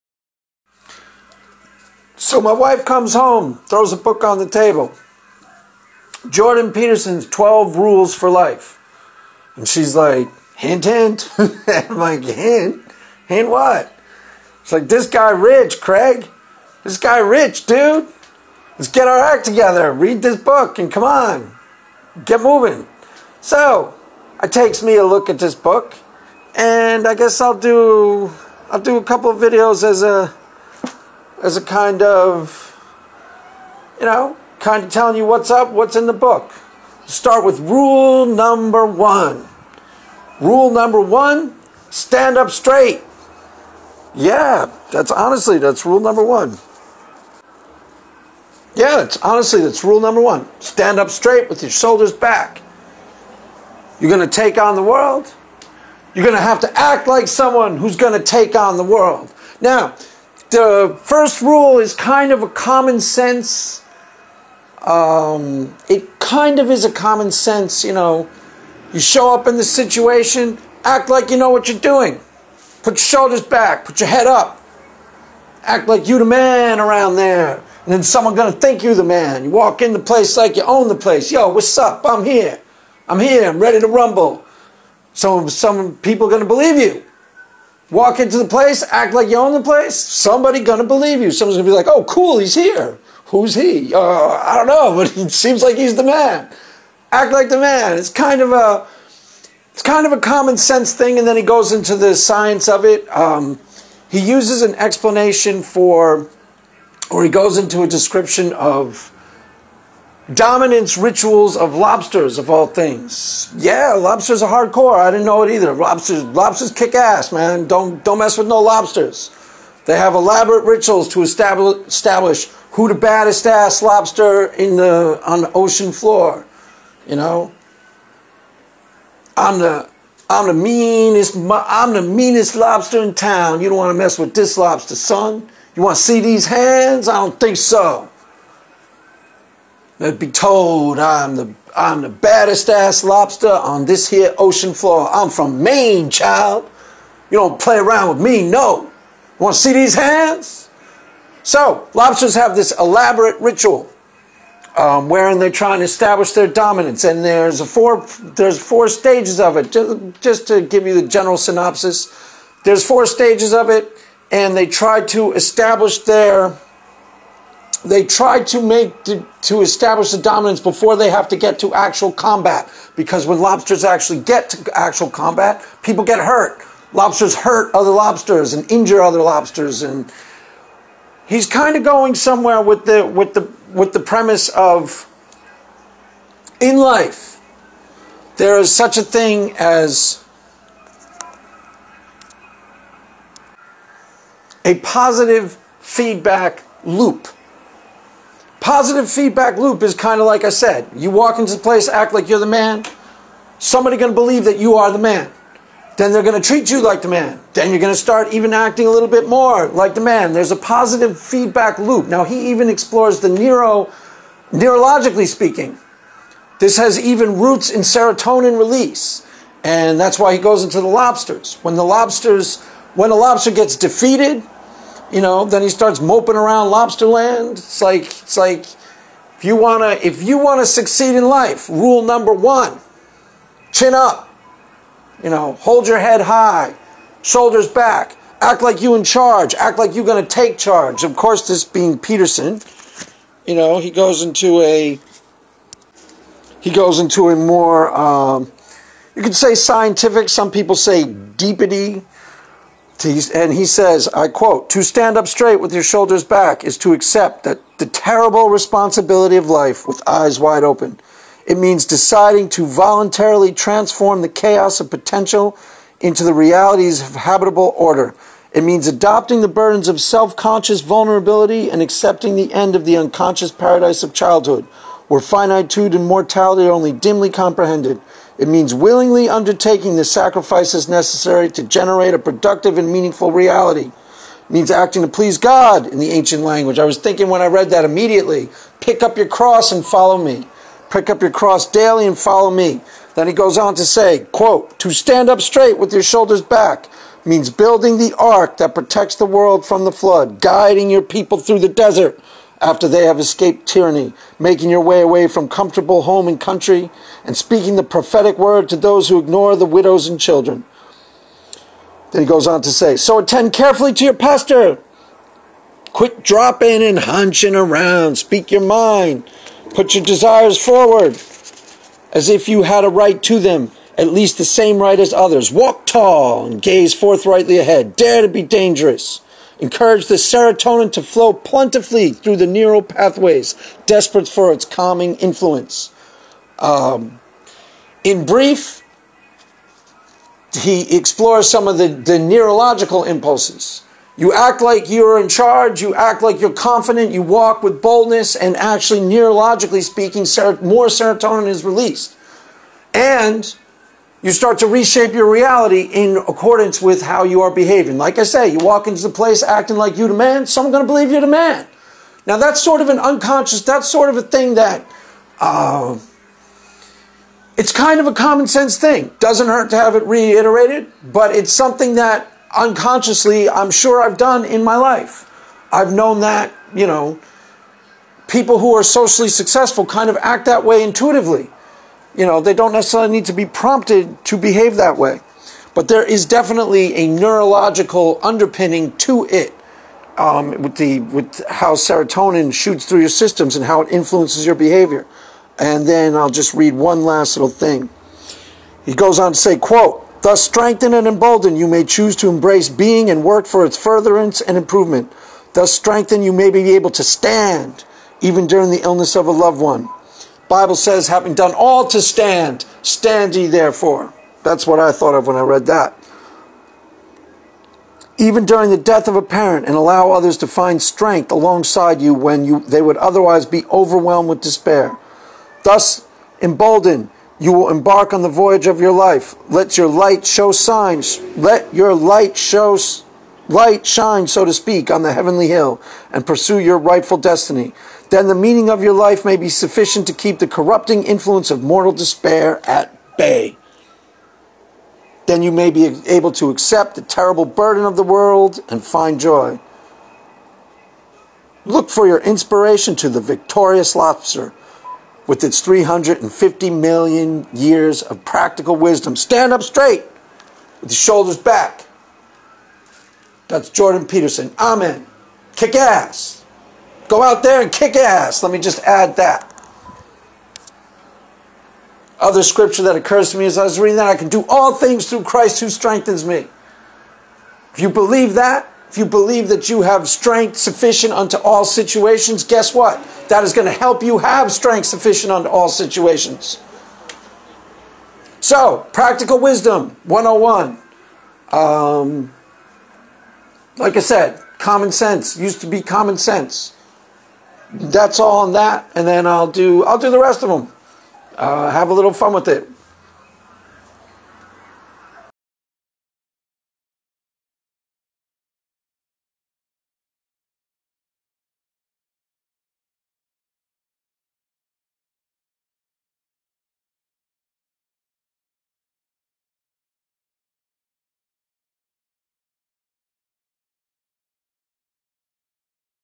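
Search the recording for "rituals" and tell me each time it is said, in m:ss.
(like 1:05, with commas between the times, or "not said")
1:50, 2:00, 2:33.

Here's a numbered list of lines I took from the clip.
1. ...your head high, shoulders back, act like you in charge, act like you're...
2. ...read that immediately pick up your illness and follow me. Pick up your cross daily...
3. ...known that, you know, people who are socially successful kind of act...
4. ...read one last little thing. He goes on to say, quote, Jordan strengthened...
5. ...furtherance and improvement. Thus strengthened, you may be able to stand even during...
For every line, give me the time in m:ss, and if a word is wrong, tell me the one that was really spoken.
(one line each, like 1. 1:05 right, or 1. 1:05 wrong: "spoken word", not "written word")
1. 3:55 right
2. 4:47 wrong: "cross", not "illness"
3. 6:15 right
4. 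6:36 wrong: "Thus", not "Jordan"
5. 6:43 right.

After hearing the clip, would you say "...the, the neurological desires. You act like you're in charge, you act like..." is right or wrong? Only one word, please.
wrong.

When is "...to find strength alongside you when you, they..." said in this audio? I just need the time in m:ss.
7:00.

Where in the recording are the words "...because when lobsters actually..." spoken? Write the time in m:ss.
2:52.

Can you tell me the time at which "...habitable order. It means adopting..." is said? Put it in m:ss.
4:27.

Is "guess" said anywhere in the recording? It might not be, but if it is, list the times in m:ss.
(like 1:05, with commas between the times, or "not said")
0:27, 8:02.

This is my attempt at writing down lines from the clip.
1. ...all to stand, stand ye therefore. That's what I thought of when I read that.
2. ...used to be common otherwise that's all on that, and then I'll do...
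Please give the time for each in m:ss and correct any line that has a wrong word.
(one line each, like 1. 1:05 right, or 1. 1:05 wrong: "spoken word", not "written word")
1. 6:51 right
2. 8:15 wrong: "sense", not "otherwise".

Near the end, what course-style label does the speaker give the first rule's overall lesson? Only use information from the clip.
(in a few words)
Practical wisdom 101.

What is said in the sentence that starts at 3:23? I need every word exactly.
Somebody going to believe that you are the man.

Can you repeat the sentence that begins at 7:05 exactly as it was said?
Thus emboldened, you will embark on the voyage of your life.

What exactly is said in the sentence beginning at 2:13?
You don't want to mess with this lobster, son.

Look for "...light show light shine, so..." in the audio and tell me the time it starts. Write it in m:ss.
7:11.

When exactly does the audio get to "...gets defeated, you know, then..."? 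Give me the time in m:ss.
3:43.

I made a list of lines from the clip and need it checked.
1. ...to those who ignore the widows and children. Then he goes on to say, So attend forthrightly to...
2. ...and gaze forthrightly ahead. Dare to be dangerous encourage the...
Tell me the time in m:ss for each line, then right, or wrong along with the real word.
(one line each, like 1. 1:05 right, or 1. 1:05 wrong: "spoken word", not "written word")
1. 5:08 wrong: "carefully", not "forthrightly"
2. 5:26 right.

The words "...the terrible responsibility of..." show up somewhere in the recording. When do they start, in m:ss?
4:17.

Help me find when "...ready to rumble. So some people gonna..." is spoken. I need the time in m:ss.
1:23.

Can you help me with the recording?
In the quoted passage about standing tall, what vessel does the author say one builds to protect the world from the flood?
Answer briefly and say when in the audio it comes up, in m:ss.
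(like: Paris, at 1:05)
The ark, at 4:57.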